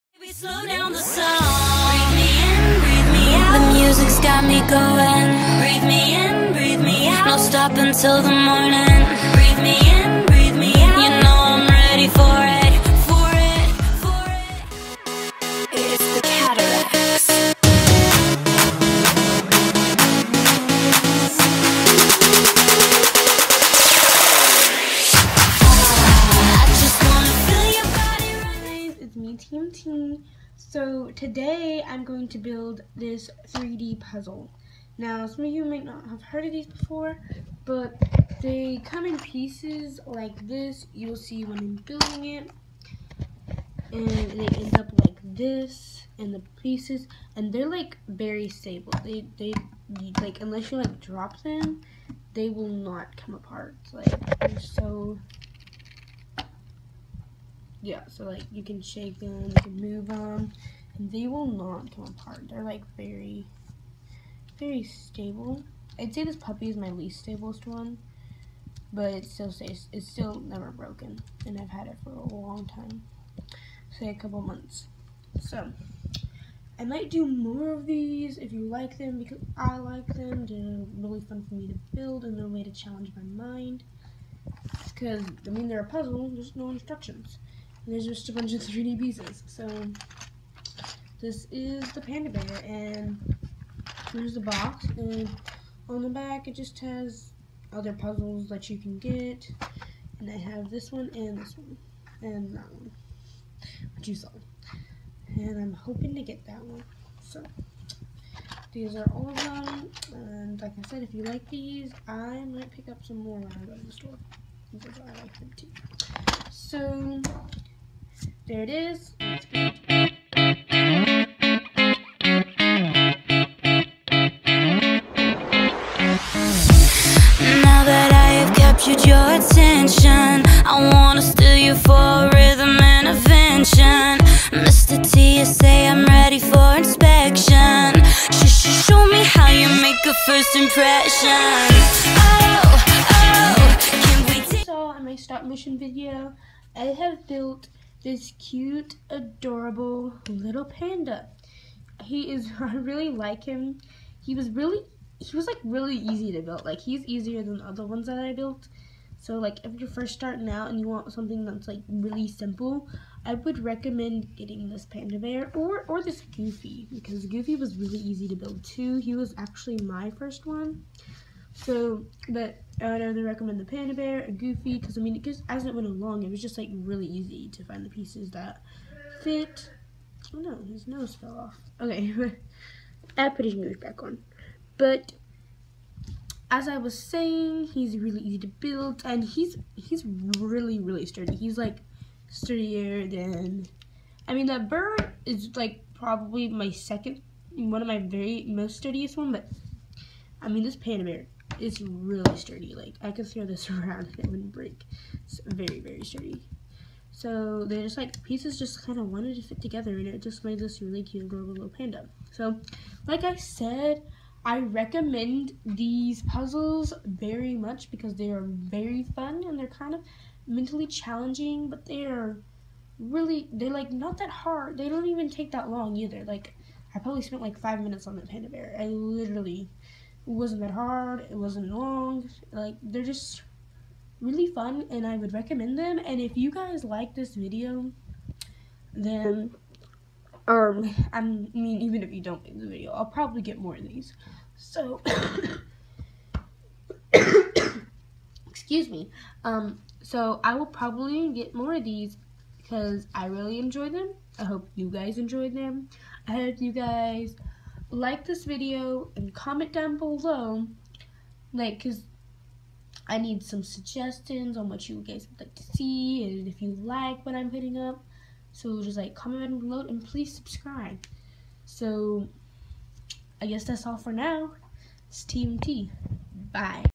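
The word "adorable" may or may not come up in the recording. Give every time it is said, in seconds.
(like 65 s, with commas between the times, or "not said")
149 s, 211 s.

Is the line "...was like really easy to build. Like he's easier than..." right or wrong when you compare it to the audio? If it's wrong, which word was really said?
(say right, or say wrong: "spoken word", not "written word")
right.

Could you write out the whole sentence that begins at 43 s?
And they end up like this and the pieces and they're like very stable.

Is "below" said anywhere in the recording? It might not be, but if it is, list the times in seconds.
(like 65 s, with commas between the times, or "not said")
259 s, 269 s.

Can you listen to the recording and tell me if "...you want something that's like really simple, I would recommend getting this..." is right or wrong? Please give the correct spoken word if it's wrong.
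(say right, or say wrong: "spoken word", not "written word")
right.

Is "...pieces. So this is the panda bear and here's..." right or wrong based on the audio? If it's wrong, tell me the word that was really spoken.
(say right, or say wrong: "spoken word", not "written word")
right.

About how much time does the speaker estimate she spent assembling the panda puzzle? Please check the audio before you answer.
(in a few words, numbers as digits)
5 minutes.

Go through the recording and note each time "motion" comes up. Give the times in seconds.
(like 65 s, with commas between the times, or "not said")
145 s.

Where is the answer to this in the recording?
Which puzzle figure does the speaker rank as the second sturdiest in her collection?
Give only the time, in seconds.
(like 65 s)
194 s.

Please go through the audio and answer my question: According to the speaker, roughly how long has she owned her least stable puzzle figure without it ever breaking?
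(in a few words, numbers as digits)
a couple months.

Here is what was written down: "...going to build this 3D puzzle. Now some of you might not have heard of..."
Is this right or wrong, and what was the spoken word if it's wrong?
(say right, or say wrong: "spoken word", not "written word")
right.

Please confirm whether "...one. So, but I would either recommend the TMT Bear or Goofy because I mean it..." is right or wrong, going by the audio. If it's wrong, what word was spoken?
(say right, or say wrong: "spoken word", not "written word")
wrong: "Panda", not "TMT".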